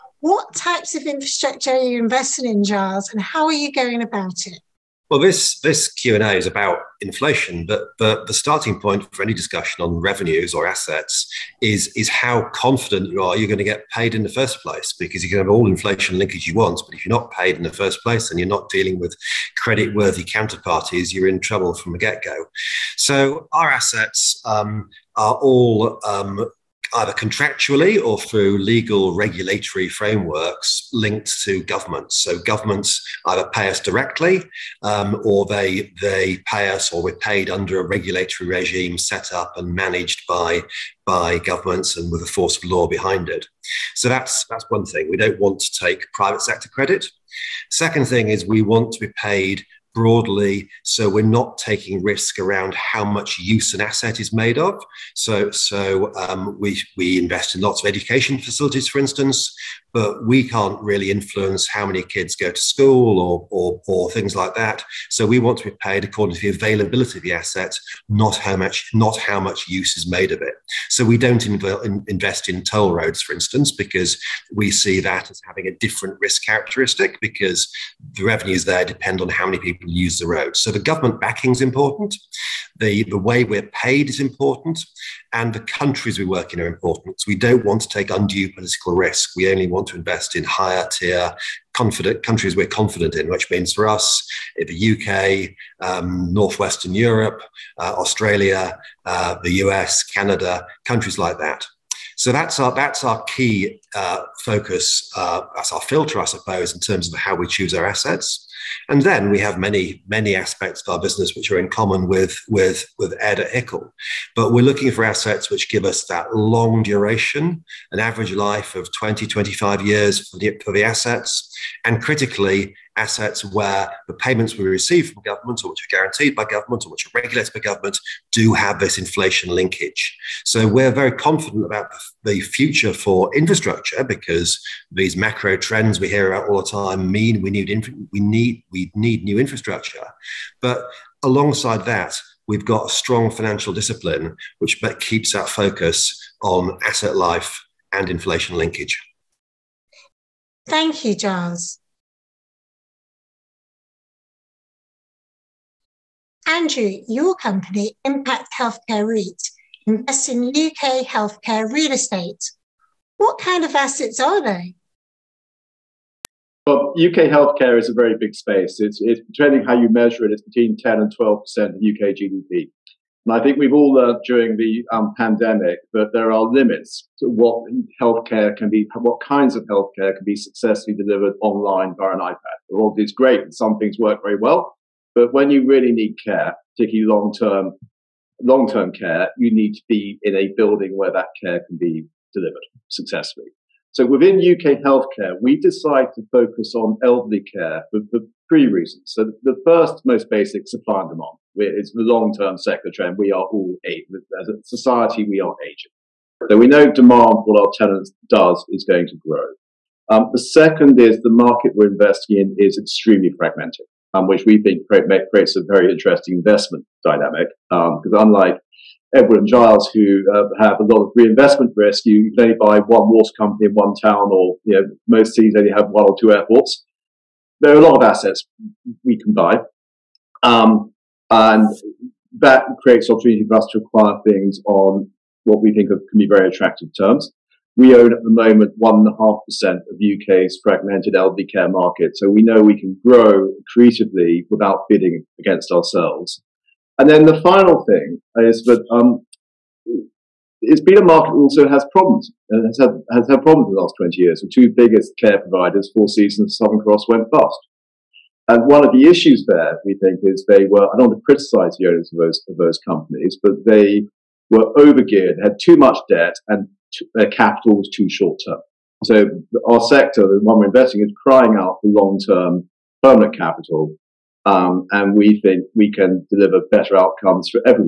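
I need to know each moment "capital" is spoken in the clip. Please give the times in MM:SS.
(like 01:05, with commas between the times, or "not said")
04:27, 04:33.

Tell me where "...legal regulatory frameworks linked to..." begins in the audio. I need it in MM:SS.
00:28.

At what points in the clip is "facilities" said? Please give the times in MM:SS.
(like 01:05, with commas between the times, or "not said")
00:58.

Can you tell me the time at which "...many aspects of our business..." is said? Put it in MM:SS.
01:50.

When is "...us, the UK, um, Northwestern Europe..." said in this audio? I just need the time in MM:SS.
01:33.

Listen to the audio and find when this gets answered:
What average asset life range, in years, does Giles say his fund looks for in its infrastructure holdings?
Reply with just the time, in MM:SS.
01:58.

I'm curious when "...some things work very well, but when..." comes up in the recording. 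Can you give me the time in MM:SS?
03:03.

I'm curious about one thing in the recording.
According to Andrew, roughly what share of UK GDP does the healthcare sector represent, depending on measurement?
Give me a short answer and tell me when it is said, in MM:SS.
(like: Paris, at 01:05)
10 to 12%, at 02:50.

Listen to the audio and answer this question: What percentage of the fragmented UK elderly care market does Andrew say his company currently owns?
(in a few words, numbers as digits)
1.5%.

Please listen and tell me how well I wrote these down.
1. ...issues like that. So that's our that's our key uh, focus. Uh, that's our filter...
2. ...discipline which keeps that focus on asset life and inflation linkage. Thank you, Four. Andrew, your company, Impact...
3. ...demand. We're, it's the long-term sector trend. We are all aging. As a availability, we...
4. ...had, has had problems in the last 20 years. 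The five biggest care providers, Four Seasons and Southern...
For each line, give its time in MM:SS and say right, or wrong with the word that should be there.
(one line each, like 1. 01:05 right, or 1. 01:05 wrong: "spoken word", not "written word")
1. 01:40 wrong: "countries", not "issues"
2. 02:23 wrong: "Giles", not "Four"
3. 03:21 wrong: "society", not "availability"
4. 04:12 wrong: "two", not "five".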